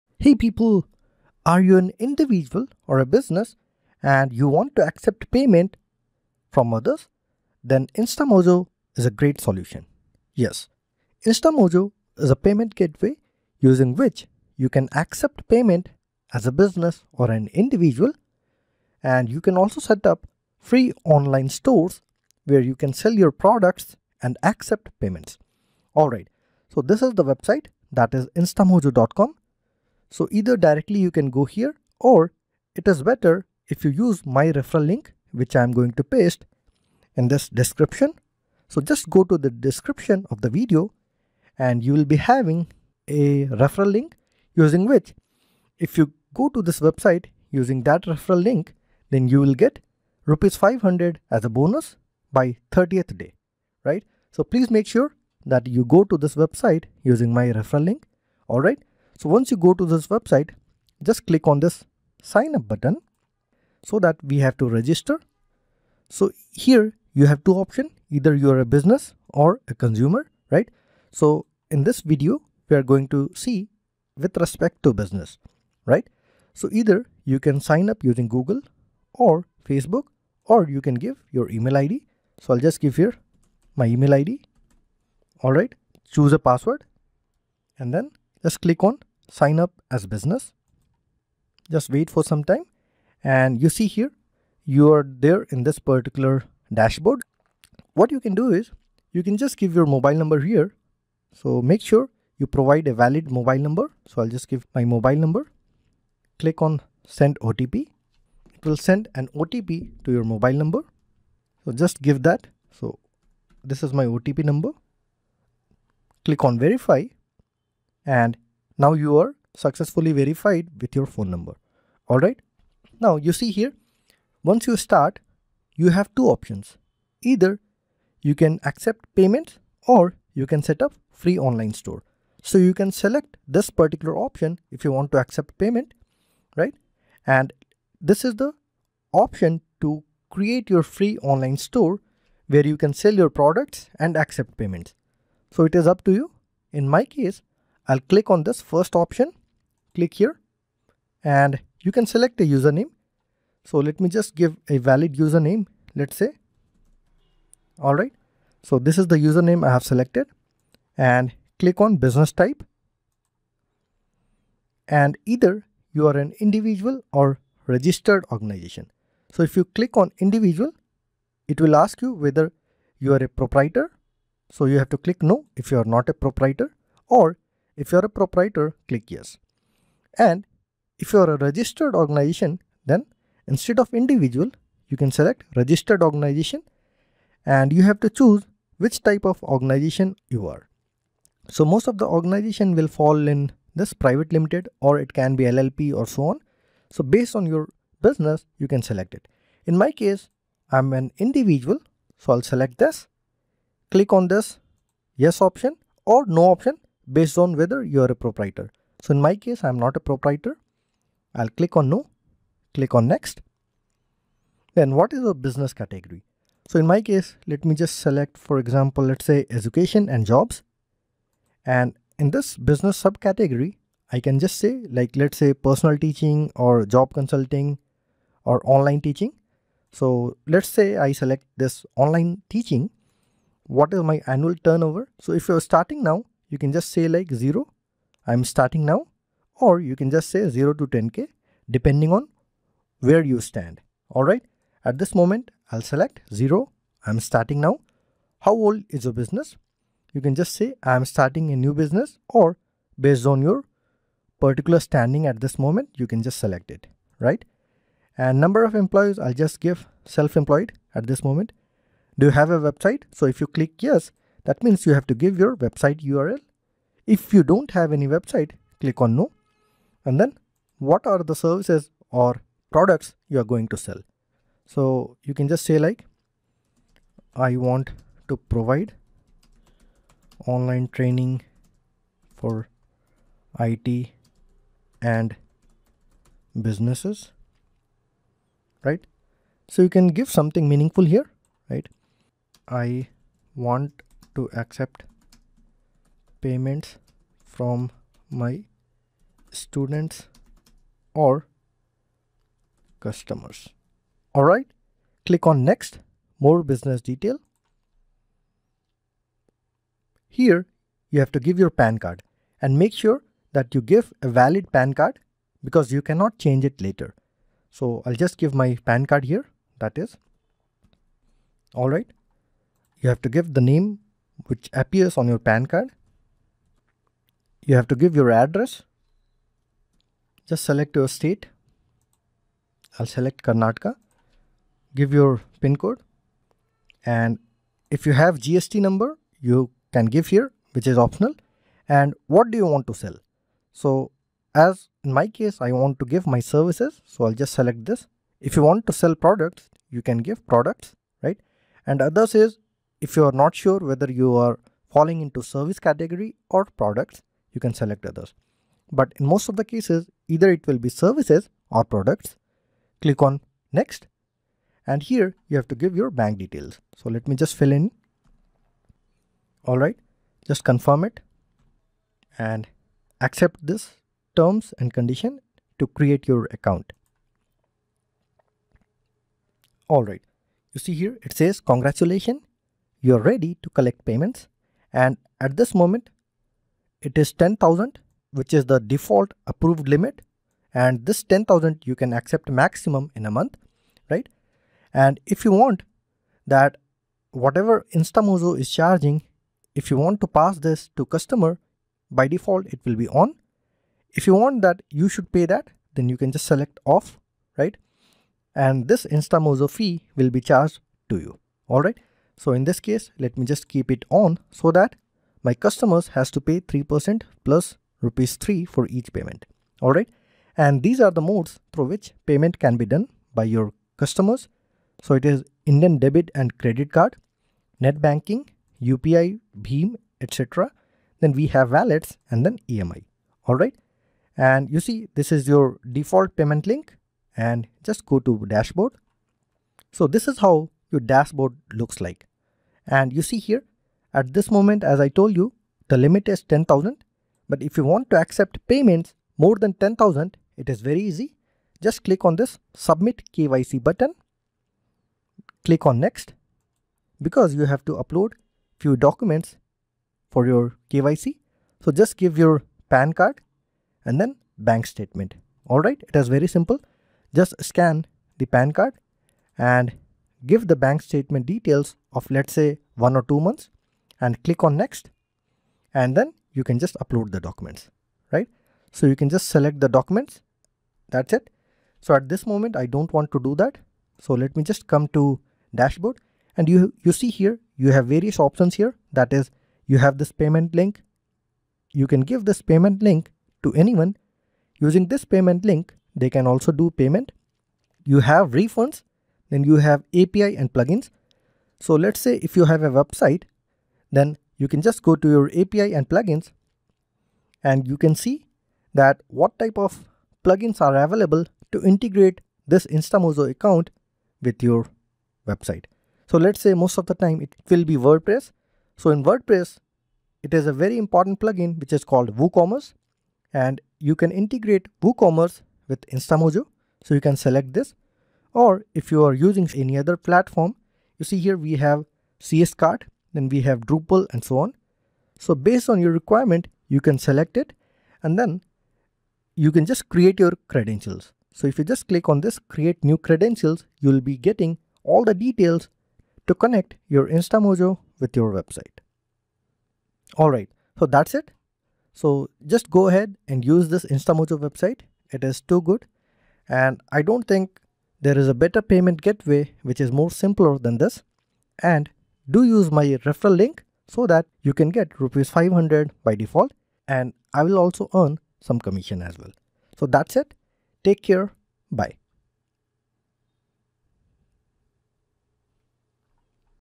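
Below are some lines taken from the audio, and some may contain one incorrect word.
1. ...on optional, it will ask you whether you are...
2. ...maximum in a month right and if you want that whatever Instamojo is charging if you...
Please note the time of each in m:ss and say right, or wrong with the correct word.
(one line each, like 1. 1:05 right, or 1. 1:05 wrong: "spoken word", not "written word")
1. 2:49 wrong: "individual", not "optional"
2. 6:32 right.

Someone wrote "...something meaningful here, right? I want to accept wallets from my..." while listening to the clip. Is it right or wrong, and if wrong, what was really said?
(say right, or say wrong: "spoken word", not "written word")
wrong: "payments", not "wallets".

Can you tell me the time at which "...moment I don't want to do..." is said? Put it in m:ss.
8:02.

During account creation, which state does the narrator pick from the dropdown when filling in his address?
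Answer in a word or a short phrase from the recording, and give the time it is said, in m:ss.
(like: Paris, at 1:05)
Karnataka, at 5:33.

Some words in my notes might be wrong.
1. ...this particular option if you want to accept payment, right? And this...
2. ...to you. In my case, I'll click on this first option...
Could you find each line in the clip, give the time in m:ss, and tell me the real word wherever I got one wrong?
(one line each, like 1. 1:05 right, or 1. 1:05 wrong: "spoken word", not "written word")
1. 2:13 right
2. 2:26 right.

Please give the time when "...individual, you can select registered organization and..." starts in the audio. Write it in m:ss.
3:03.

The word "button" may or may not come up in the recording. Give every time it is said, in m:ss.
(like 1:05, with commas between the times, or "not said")
1:02, 7:33.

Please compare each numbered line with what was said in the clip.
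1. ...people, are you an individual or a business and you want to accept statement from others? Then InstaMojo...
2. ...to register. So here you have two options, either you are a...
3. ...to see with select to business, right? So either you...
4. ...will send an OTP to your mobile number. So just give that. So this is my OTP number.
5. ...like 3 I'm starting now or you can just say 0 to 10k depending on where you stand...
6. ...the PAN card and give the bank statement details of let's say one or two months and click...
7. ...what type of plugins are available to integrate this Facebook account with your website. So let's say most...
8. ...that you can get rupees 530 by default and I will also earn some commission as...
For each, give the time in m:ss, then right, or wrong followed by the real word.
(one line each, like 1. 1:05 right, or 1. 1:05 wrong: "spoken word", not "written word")
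1. 0:00 wrong: "payment", not "statement"
2. 1:04 right
3. 1:13 wrong: "respect", not "select"
4. 1:48 right
5. 3:57 wrong: "0", not "3"
6. 7:48 right
7. 8:29 wrong: "Instamojo", not "Facebook"
8. 9:24 wrong: "500", not "530".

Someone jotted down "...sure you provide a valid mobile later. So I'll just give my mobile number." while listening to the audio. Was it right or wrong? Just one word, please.
wrong.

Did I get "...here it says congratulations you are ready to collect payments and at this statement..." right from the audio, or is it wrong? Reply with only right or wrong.
wrong.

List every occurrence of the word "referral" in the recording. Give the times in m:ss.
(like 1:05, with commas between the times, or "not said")
0:34, 0:43, 0:48, 0:57, 9:23.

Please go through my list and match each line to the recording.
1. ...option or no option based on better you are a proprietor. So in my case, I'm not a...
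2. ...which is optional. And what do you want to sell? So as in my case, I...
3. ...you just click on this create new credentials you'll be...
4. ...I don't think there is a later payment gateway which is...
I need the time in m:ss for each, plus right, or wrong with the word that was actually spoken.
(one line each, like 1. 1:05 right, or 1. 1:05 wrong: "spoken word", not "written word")
1. 3:25 wrong: "whether", not "better"
2. 5:40 right
3. 9:01 right
4. 9:17 wrong: "better", not "later".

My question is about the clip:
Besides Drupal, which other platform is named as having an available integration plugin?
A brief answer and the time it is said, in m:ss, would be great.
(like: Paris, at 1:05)
CS-Cart, at 8:52.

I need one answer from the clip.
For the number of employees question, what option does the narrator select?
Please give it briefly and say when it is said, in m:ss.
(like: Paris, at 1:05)
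Self-employed, at 4:20.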